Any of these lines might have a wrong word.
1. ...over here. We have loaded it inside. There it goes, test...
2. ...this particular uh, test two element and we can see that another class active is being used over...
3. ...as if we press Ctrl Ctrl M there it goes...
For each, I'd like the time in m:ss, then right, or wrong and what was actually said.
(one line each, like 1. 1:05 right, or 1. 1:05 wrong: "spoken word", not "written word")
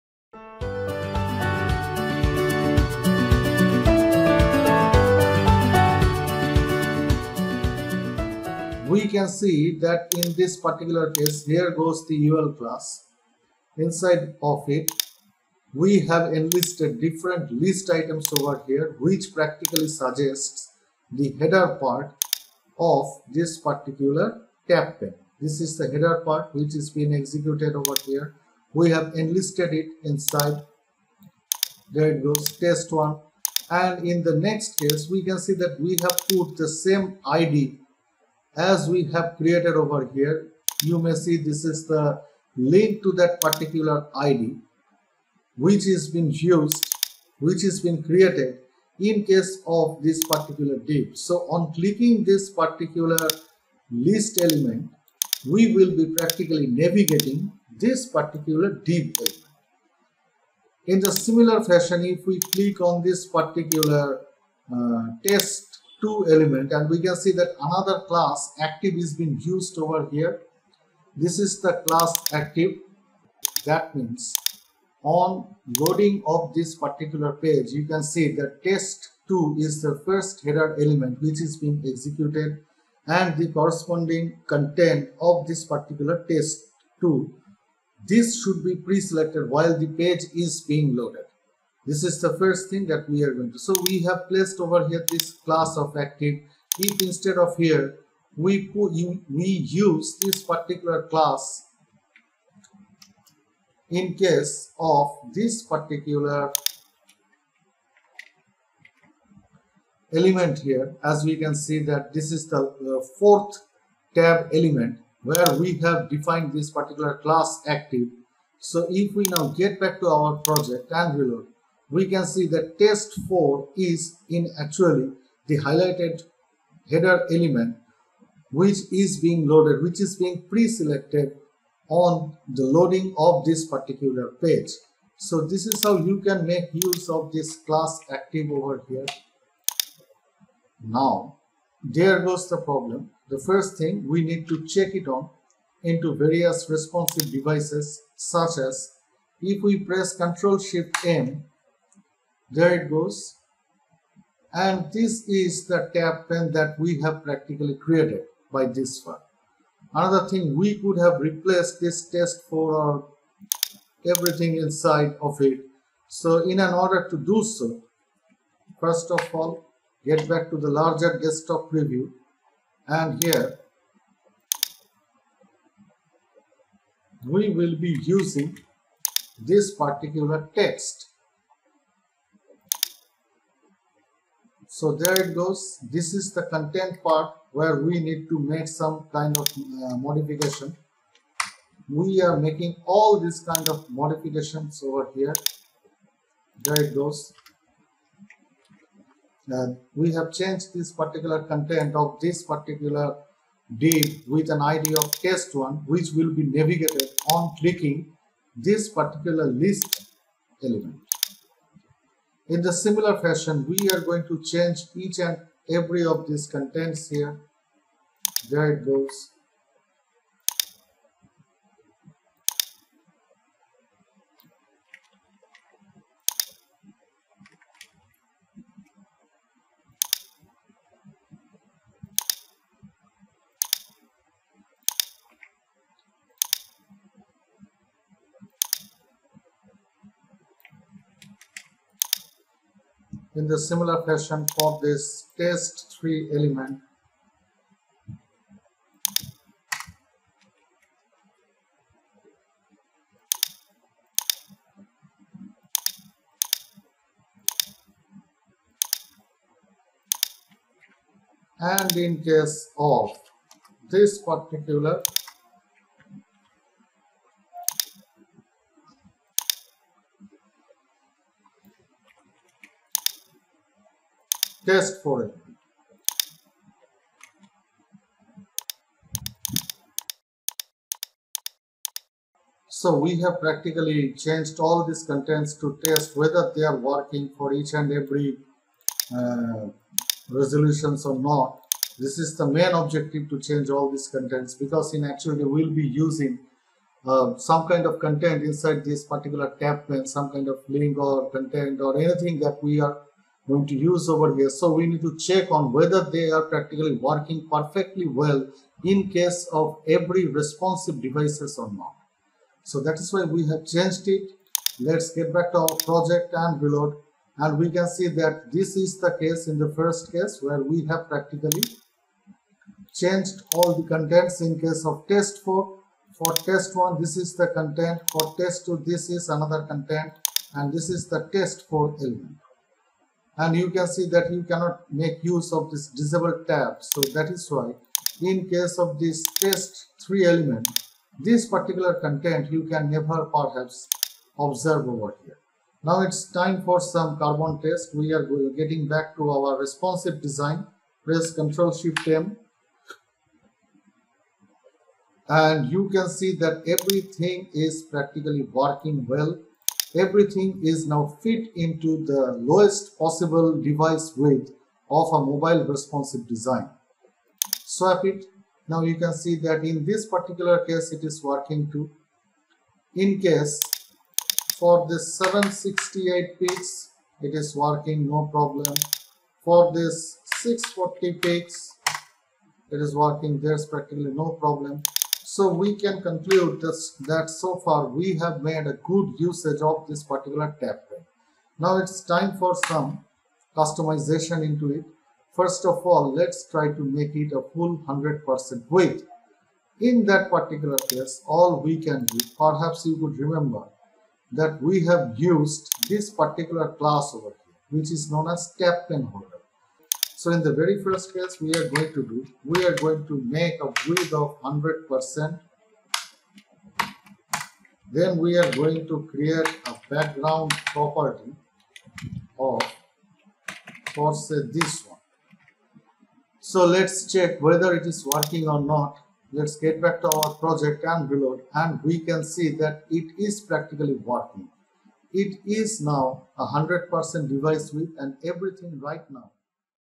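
1. 0:27 wrong: "enlisted", not "loaded"
2. 1:03 right
3. 2:28 wrong: "Shift", not "Ctrl".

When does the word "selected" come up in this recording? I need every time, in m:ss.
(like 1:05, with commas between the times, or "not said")
1:28, 2:10.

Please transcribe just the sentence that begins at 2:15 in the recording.
So this is how you can make use of this class active over here.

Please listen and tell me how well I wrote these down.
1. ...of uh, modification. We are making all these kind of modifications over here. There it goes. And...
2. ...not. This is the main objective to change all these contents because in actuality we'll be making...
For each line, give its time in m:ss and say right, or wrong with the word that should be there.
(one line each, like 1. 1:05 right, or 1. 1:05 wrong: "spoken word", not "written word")
1. 3:09 right
2. 4:51 wrong: "using", not "making".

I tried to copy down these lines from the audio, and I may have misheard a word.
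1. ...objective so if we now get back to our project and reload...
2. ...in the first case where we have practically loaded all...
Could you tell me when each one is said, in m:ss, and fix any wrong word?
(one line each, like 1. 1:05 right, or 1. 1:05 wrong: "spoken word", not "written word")
1. 1:57 wrong: "active", not "objective"
2. 5:19 wrong: "changed", not "loaded".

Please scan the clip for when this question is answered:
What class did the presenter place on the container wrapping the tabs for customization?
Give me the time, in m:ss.
6:48.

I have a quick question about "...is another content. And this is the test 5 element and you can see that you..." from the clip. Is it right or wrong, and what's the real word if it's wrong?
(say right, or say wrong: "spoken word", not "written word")
wrong: "4", not "5".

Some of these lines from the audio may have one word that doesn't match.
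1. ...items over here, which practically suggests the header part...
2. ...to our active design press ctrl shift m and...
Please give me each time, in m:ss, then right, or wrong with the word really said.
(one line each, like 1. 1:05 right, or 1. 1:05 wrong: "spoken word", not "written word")
1. 0:17 right
2. 5:49 wrong: "responsive", not "active".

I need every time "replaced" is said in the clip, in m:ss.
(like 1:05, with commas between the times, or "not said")
2:41.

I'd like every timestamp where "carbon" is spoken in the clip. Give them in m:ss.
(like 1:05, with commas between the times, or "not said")
5:47.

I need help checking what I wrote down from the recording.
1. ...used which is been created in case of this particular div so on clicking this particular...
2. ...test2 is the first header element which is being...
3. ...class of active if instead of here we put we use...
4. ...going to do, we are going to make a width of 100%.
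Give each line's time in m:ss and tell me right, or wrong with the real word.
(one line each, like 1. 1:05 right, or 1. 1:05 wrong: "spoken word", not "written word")
1. 0:46 right
2. 1:18 right
3. 1:35 right
4. 6:51 right.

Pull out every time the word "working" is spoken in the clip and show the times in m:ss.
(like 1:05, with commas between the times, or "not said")
4:46, 5:06, 5:58, 6:11, 6:17, 6:22, 7:08, 7:13.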